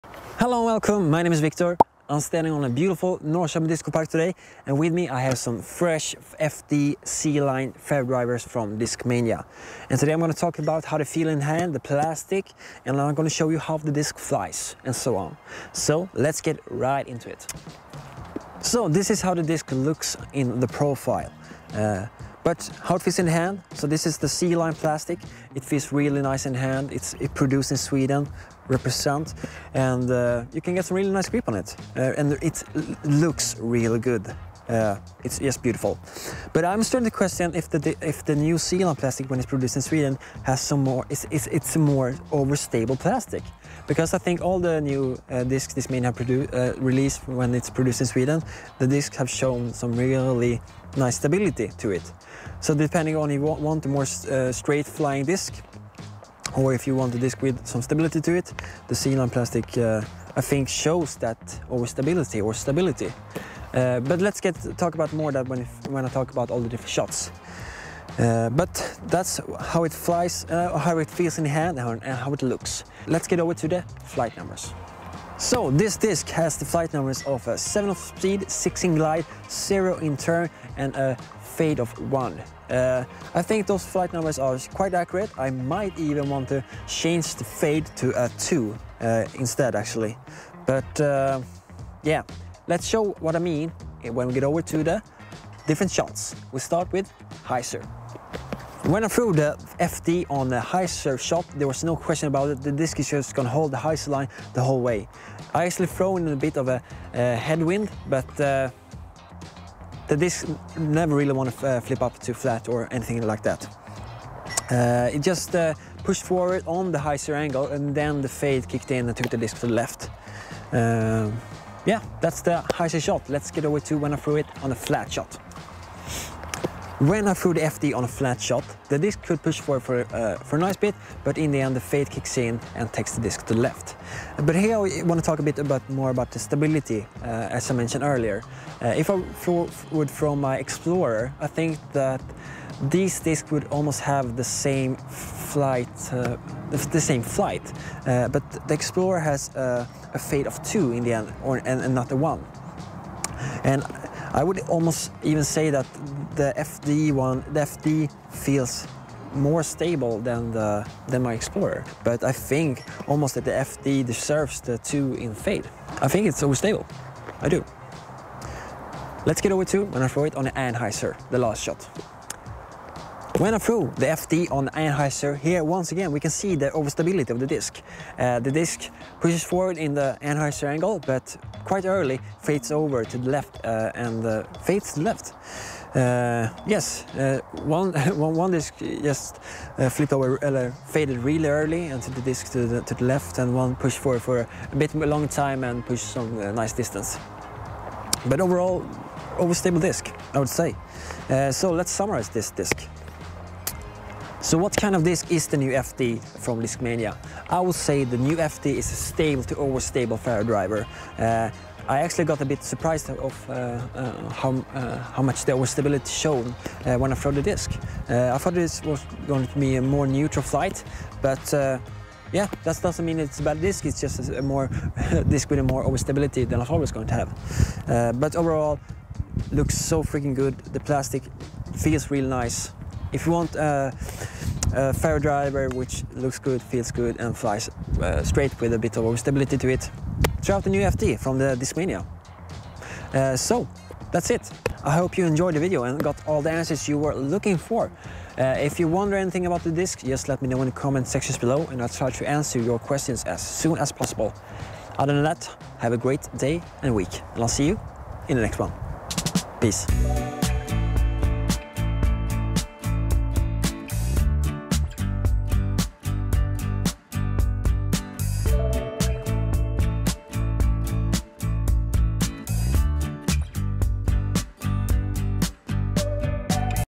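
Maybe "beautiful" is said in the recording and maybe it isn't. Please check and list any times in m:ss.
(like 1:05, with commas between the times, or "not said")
0:02, 0:35.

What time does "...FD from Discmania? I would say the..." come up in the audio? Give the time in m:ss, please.
3:25.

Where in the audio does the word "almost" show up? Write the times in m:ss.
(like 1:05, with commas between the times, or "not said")
2:23, 2:34, 2:43.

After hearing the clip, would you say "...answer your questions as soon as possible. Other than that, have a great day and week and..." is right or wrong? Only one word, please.
right.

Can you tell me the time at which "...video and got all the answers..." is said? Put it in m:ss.
4:05.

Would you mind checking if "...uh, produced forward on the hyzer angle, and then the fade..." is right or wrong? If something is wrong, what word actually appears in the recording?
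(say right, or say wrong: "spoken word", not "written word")
wrong: "pushed", not "produced".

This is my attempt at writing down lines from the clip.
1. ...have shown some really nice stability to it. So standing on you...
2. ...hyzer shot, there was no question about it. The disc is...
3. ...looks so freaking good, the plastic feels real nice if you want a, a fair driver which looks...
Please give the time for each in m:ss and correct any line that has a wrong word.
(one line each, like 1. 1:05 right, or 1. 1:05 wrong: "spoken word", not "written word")
1. 0:49 wrong: "depending", not "standing"
2. 1:40 right
3. 3:49 right.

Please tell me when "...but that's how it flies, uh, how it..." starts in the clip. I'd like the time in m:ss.
1:08.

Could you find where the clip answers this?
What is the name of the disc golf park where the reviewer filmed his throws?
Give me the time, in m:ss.
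0:03.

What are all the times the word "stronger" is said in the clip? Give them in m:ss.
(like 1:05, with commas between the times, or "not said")
not said.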